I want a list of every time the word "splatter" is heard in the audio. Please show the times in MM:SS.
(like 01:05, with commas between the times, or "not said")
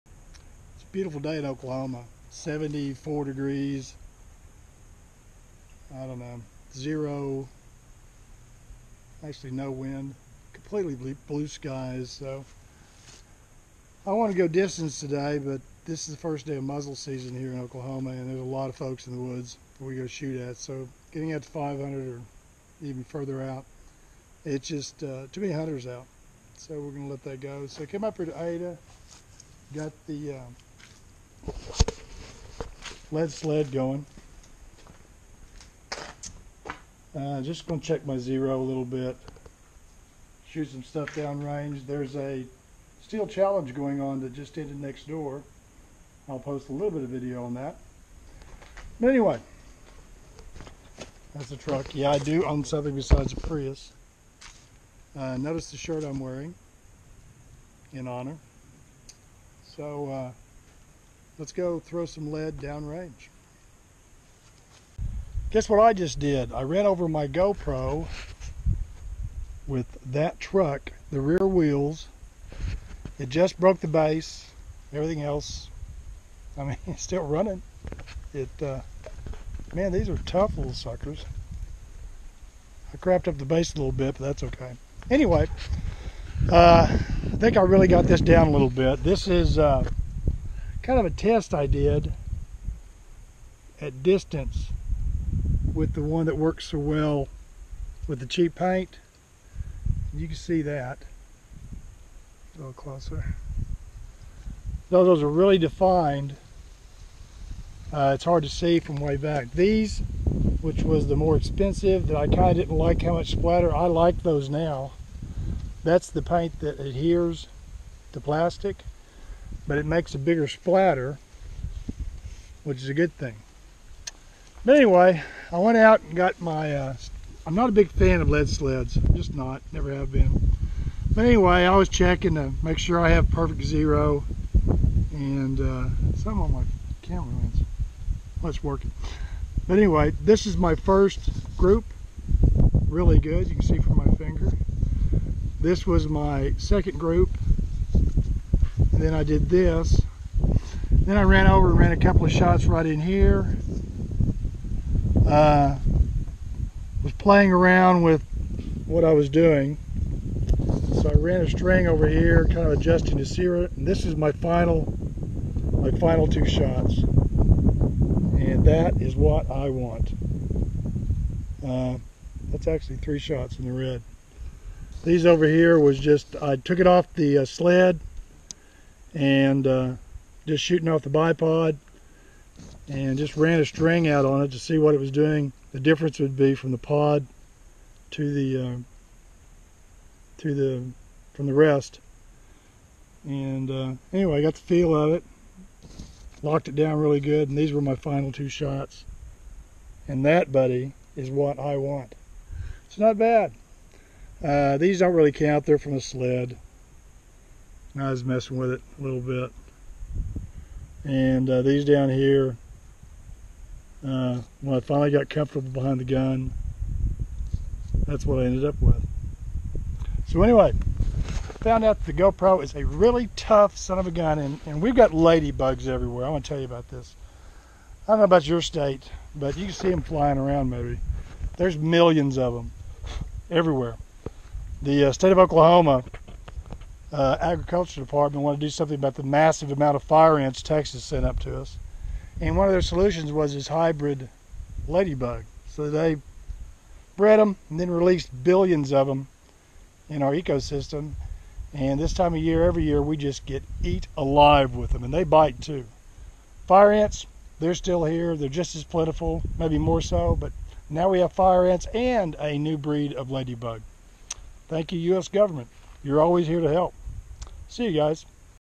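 01:53, 02:00.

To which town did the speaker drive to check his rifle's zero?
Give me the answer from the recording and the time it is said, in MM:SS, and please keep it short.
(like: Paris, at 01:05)
Ada, at 00:28.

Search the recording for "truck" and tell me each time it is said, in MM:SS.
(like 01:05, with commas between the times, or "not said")
00:51, 01:10.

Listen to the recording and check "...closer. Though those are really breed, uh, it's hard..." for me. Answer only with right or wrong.
wrong.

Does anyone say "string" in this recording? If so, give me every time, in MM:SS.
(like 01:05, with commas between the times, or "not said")
02:41, 03:03.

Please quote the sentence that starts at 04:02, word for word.
And one of their solutions was this hybrid ladybug.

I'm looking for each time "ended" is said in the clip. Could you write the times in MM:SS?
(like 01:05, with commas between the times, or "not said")
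00:44, 03:38.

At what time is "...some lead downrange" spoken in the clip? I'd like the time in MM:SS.
01:02.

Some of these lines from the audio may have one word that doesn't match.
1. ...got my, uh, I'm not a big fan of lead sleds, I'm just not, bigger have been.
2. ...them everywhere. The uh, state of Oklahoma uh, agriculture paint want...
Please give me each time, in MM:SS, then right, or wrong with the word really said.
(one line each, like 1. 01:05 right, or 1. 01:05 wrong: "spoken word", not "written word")
1. 02:06 wrong: "never", not "bigger"
2. 03:52 wrong: "department", not "paint".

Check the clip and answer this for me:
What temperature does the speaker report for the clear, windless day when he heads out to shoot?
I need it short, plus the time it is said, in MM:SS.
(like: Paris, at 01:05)
74 degrees, at 00:02.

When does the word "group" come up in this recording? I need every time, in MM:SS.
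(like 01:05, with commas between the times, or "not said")
02:21, 02:26.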